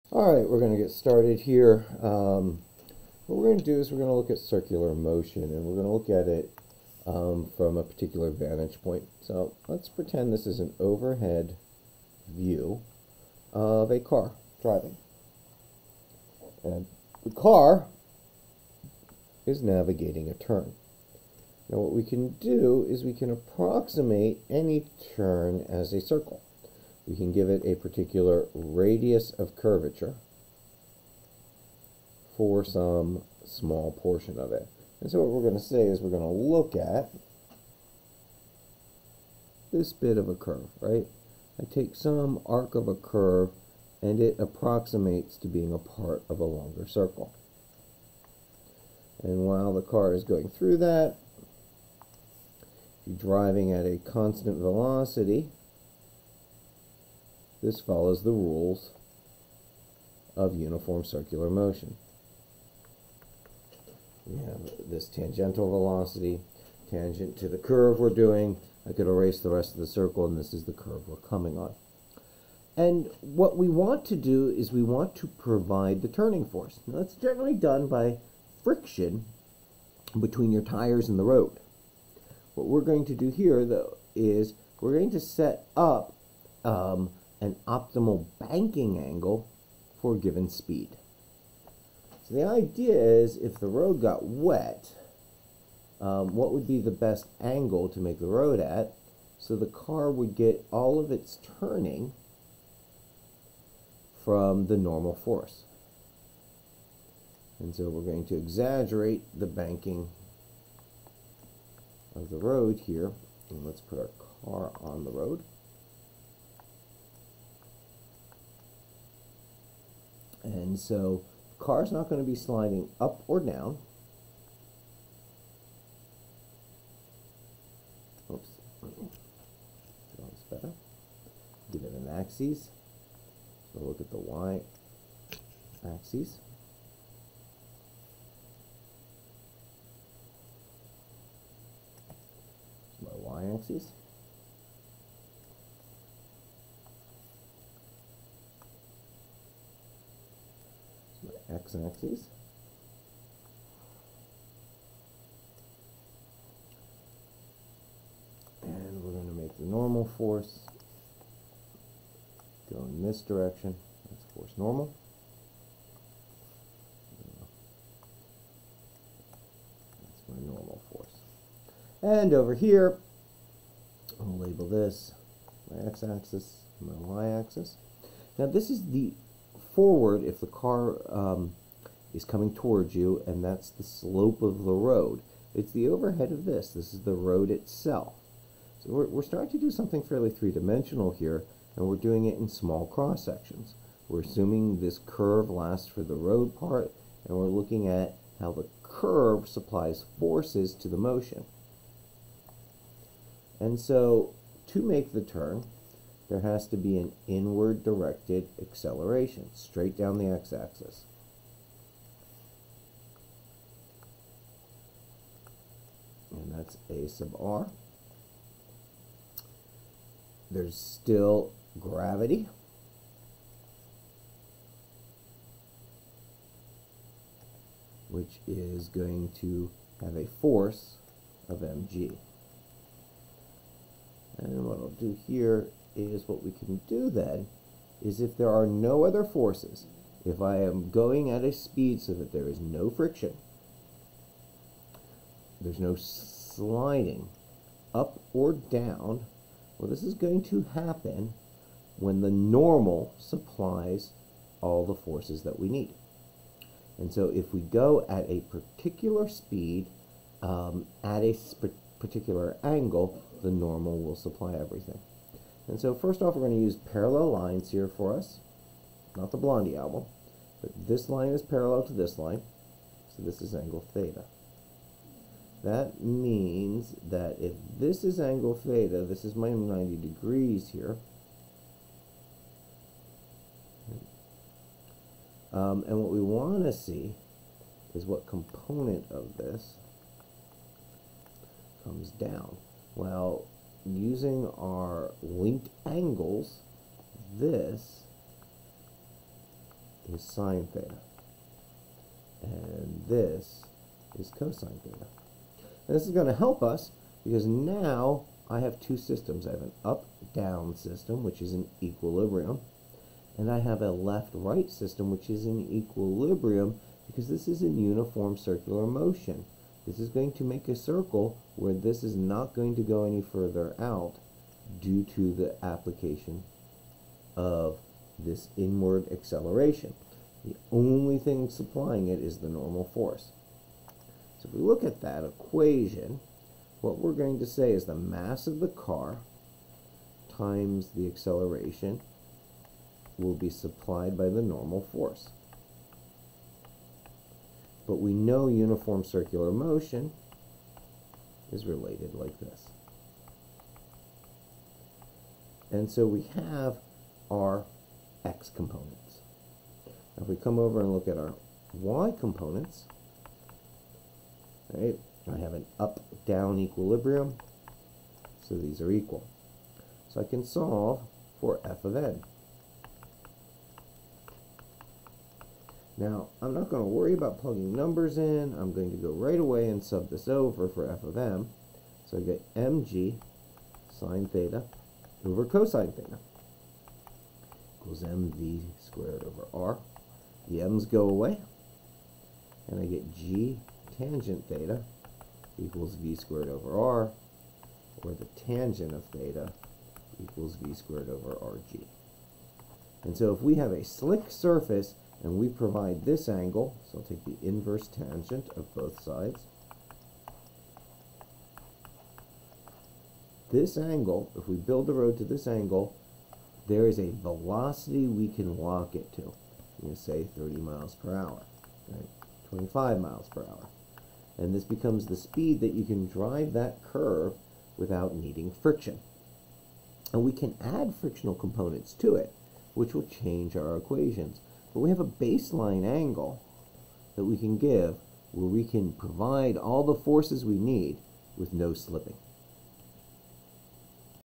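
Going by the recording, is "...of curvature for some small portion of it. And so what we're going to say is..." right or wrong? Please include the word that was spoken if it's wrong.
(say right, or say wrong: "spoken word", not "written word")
right.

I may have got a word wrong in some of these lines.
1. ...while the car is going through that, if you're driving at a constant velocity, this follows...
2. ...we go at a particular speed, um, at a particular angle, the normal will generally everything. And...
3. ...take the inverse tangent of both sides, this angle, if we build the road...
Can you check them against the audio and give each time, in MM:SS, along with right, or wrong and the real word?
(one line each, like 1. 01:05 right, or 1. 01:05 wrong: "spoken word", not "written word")
1. 00:49 right
2. 04:17 wrong: "supply", not "generally"
3. 06:47 right.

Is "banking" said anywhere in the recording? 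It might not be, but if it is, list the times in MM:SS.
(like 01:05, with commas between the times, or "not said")
01:28, 01:49.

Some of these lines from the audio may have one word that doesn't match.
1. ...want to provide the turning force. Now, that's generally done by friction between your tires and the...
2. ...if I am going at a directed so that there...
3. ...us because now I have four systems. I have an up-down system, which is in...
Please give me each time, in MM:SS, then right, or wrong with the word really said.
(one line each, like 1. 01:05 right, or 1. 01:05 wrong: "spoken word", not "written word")
1. 01:14 right
2. 04:00 wrong: "speed", not "directed"
3. 05:06 wrong: "two", not "four".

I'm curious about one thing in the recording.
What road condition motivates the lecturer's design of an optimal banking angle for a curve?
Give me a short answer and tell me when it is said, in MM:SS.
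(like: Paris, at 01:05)
wet, at 01:34.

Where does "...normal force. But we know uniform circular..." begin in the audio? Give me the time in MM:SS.
05:44.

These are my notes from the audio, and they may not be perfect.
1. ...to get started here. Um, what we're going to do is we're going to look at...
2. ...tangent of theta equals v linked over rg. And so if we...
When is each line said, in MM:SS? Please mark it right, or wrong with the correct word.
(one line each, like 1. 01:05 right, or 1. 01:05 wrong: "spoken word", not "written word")
1. 00:00 right
2. 06:38 wrong: "squared", not "linked".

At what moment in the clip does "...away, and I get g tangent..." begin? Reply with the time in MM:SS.
06:31.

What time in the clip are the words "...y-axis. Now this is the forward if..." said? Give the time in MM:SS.
02:56.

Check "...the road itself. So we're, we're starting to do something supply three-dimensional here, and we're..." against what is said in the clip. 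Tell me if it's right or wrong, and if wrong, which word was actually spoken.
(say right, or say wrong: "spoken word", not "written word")
wrong: "fairly", not "supply".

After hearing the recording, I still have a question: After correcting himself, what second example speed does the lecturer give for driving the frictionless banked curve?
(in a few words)
25 miles per hour.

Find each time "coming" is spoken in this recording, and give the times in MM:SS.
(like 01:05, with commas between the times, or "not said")
01:11, 03:02.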